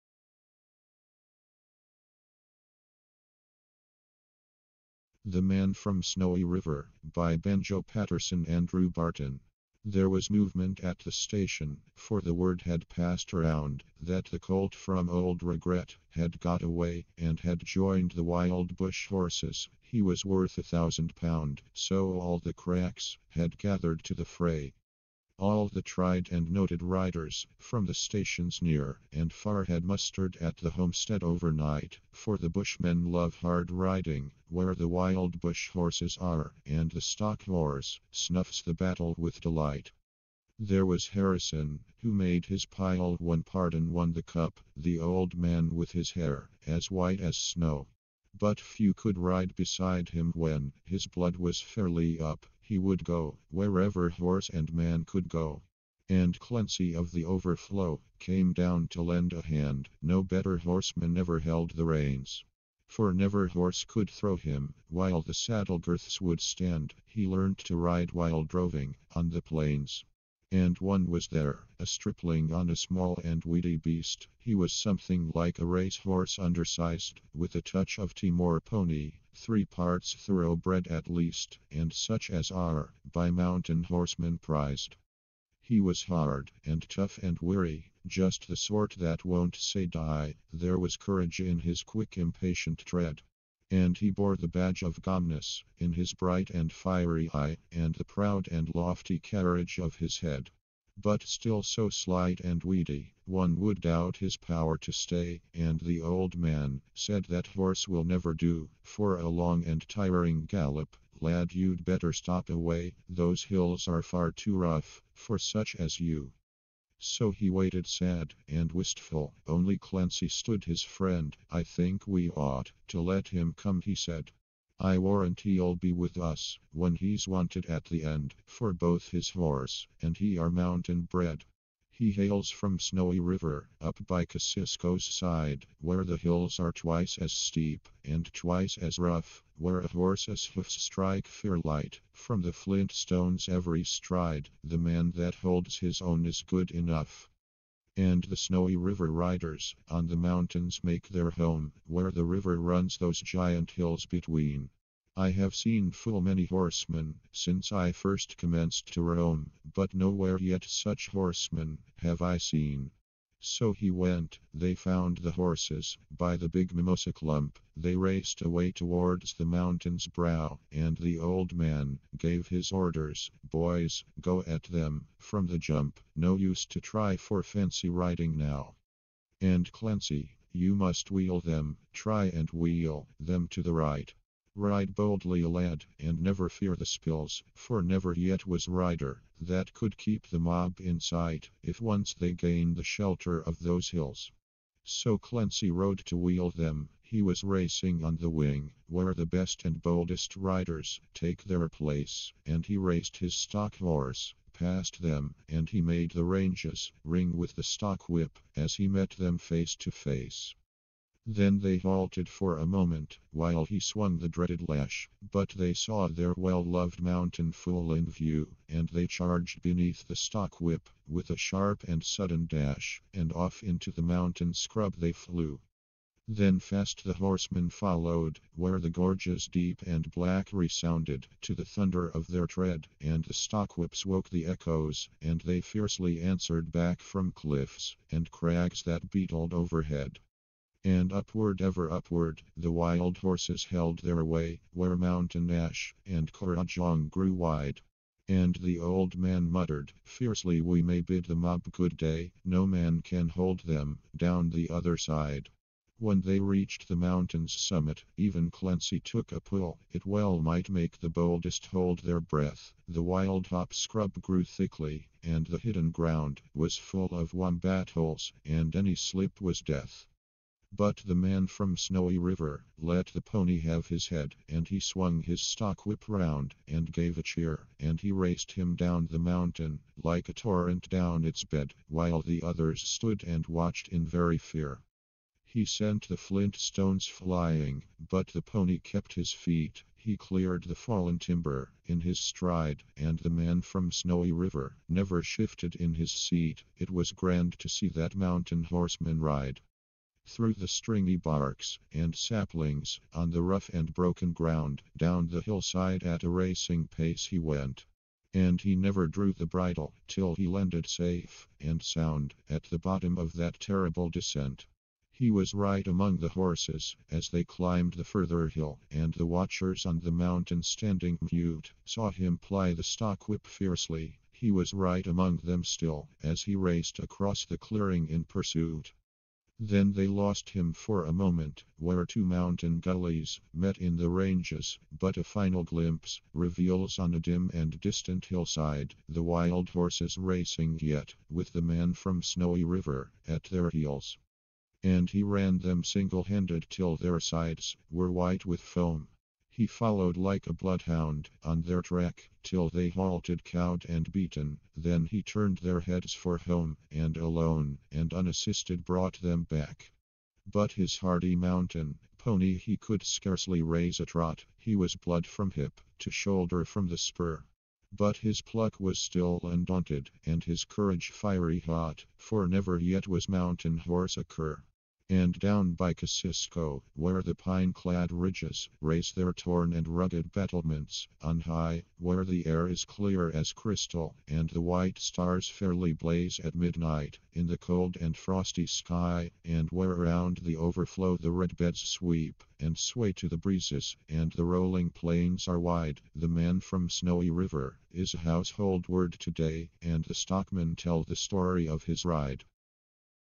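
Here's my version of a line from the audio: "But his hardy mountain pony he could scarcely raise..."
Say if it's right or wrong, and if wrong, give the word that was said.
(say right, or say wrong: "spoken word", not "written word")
right.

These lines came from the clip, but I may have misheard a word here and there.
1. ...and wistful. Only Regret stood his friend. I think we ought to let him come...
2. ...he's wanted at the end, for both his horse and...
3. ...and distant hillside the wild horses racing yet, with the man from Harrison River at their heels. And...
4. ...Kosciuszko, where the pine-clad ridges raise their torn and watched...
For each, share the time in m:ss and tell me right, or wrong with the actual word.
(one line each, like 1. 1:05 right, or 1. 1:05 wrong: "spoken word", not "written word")
1. 1:58 wrong: "Clancy", not "Regret"
2. 2:06 right
3. 5:37 wrong: "Snowy", not "Harrison"
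4. 6:15 wrong: "rugged", not "watched".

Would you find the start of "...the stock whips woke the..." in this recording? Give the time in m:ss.
3:53.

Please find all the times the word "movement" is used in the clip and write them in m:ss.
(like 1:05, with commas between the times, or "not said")
0:10.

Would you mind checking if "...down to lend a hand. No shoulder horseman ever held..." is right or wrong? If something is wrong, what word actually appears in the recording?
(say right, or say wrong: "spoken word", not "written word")
wrong: "better", not "shoulder".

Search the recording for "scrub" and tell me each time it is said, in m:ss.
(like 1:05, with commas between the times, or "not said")
3:44, 4:23.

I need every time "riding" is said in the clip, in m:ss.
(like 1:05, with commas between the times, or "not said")
0:33, 2:57.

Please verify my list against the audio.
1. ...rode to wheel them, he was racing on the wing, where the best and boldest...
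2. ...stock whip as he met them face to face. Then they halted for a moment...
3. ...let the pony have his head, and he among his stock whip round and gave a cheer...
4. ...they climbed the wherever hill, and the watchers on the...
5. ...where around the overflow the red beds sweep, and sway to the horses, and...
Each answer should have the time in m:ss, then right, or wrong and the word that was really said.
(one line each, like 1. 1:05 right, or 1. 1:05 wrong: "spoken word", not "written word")
1. 3:15 right
2. 3:27 right
3. 4:32 wrong: "swung", not "among"
4. 5:17 wrong: "further", not "wherever"
5. 6:29 wrong: "breezes", not "horses".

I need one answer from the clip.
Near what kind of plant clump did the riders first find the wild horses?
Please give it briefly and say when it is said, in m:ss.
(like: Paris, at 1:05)
Mimosa, at 2:46.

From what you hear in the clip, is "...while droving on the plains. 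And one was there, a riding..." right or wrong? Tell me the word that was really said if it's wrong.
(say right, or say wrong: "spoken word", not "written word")
wrong: "stripling", not "riding".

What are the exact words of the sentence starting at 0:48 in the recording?
But few could ride beside him when his blood was fairly up.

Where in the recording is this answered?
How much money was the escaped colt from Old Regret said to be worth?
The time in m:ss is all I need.
0:20.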